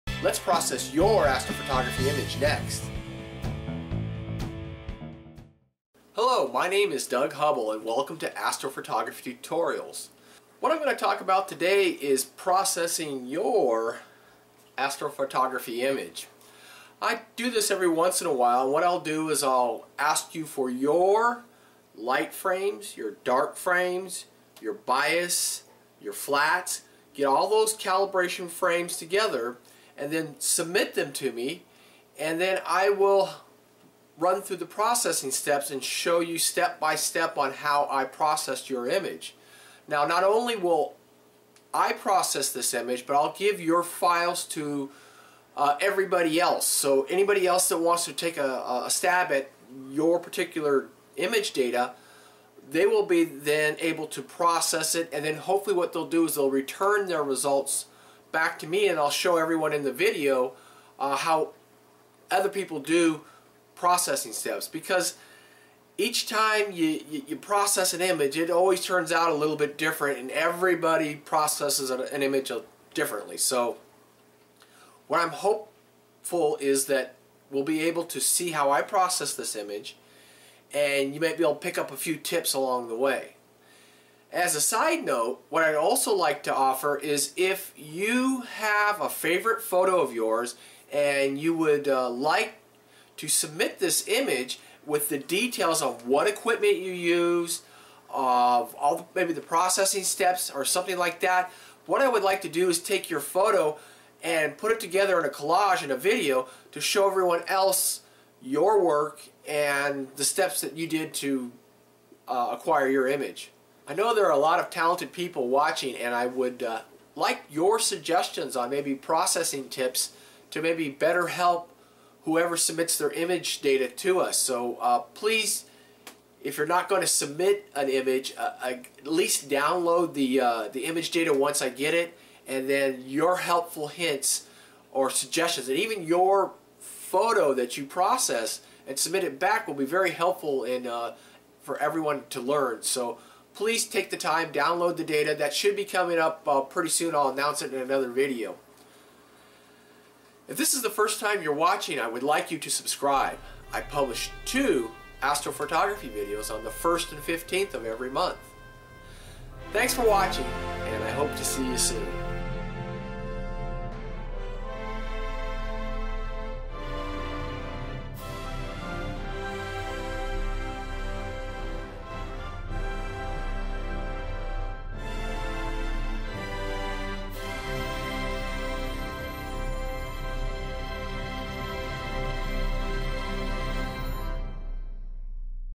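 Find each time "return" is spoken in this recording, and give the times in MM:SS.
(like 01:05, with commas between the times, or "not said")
00:56.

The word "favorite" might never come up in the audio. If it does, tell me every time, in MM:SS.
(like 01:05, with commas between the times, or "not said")
01:29.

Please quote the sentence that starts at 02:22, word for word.
So please take the time, download the data.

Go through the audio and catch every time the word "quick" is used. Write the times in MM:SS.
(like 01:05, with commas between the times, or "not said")
not said.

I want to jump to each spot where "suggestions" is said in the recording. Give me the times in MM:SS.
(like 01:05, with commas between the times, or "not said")
01:57, 02:15.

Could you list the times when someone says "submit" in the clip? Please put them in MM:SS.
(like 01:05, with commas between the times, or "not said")
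00:30, 01:33, 02:02, 02:07, 02:18.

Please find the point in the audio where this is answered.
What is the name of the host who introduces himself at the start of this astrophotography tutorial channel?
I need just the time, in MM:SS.
00:07.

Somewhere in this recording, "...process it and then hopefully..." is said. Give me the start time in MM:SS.
00:54.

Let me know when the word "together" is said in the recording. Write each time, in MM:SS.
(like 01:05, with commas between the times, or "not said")
00:28, 01:44.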